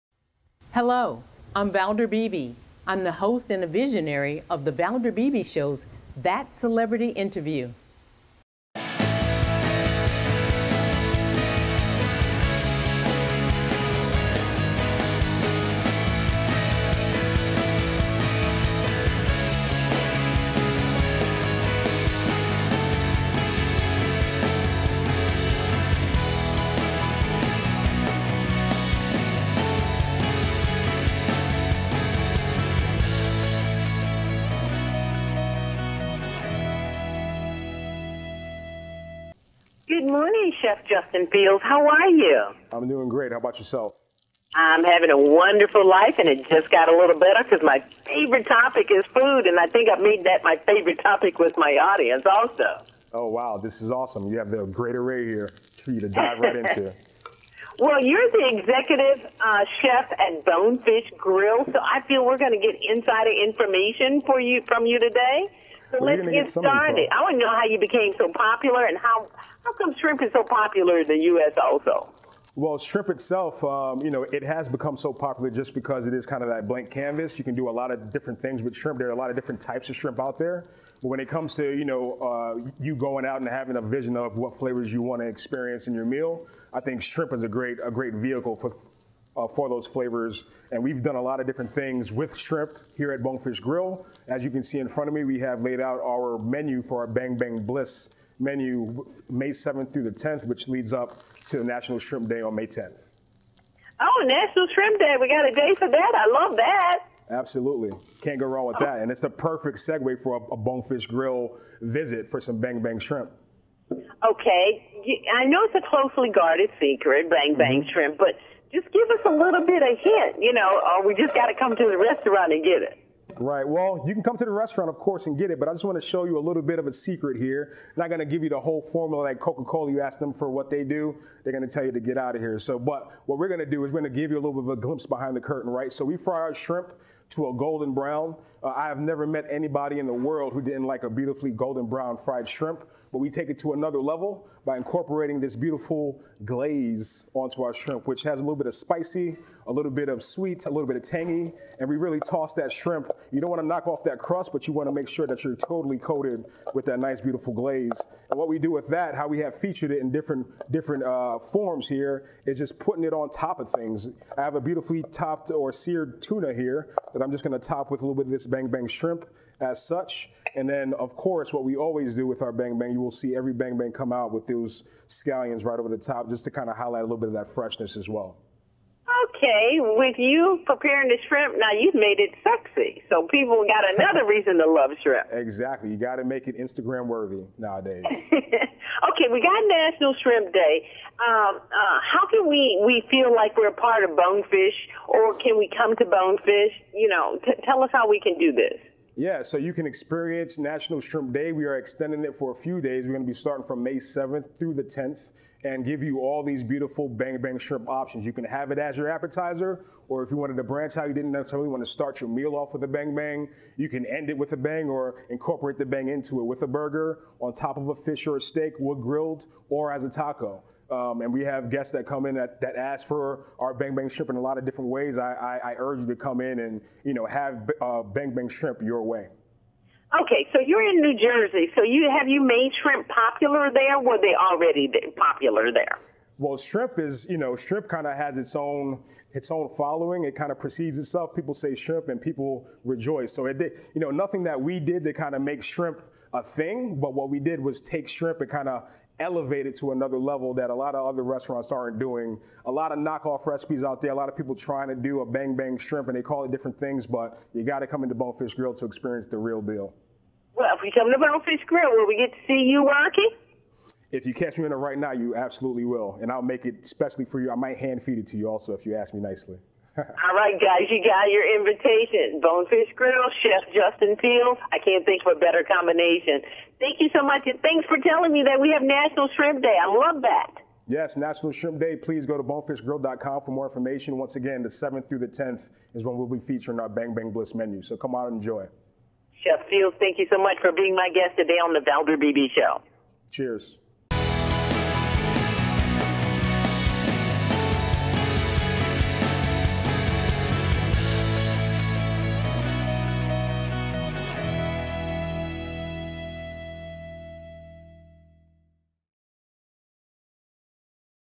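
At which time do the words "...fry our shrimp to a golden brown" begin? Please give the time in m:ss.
2:16.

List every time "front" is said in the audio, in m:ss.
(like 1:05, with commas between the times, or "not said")
1:34.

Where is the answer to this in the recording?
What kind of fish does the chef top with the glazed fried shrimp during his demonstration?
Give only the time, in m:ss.
2:45.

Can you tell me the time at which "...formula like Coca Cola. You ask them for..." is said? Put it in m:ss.
2:08.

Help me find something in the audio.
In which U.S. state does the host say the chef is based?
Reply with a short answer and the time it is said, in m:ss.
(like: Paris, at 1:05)
New Jersey, at 3:50.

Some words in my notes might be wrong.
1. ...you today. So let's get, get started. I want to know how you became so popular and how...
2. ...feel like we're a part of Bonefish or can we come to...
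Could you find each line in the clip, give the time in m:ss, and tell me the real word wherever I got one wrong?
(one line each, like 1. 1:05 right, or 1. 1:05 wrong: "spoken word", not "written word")
1. 1:04 right
2. 3:13 right.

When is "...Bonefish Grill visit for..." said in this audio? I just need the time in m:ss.
1:50.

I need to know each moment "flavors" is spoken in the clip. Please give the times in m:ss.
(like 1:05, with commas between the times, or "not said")
1:24, 1:29.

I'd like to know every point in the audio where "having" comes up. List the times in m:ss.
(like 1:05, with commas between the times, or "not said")
0:44, 1:23.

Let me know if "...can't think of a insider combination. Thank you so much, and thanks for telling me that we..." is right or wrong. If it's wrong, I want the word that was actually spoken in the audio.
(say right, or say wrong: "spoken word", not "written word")
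wrong: "better", not "insider".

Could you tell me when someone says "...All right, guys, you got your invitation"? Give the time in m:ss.
4:29.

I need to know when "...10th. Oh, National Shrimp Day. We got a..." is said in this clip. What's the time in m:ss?
1:42.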